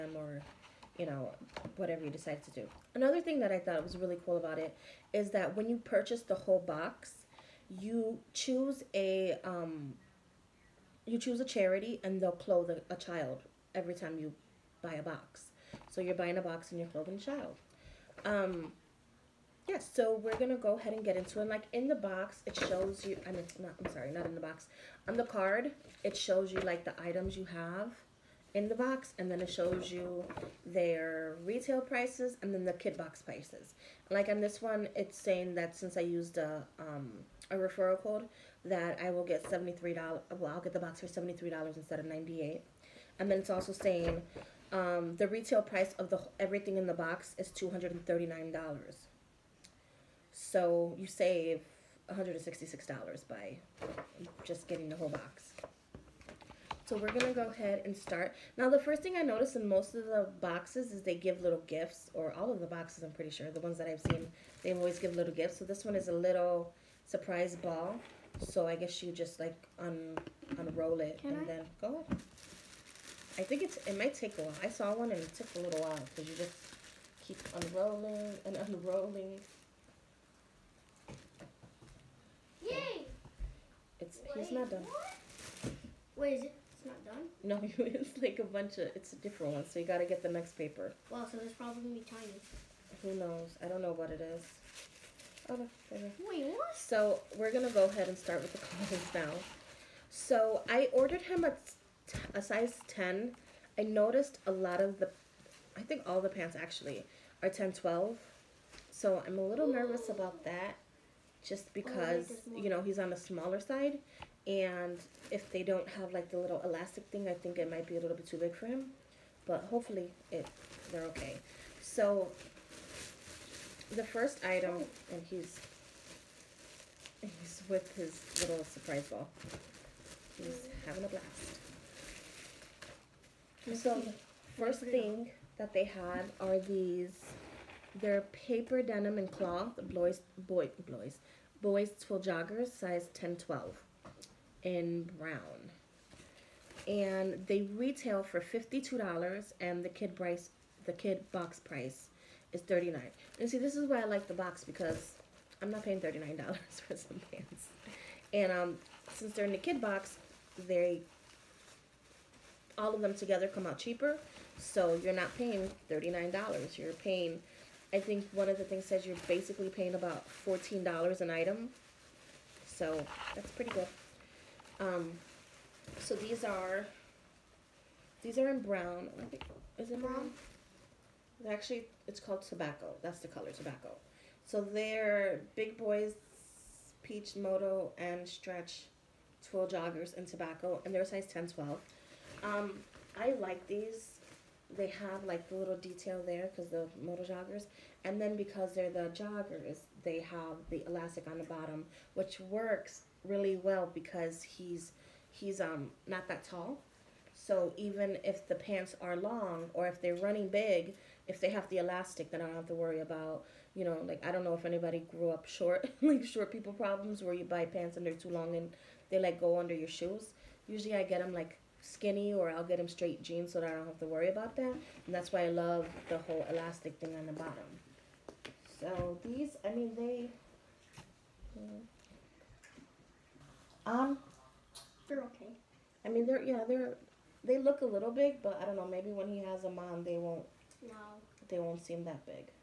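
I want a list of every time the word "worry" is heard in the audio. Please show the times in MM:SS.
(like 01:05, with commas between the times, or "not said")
03:32, 03:44.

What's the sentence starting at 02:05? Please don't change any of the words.
and he's he's with his little surprise ball he's oh.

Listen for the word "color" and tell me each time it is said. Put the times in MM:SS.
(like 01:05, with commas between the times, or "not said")
03:03.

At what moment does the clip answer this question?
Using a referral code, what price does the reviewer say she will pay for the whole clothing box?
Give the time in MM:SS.
00:40.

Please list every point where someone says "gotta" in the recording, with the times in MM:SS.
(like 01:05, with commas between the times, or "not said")
01:29.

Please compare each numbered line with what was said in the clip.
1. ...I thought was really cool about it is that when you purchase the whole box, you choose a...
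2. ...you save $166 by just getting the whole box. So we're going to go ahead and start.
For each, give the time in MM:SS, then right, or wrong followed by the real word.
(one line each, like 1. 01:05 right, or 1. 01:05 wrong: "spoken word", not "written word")
1. 00:03 right
2. 00:50 right.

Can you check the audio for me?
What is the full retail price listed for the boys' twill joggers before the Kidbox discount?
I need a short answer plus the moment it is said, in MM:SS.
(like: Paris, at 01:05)
$52, at 02:28.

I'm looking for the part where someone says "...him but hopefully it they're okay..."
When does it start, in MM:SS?
01:58.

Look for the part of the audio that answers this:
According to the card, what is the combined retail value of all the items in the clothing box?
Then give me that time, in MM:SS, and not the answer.
00:47.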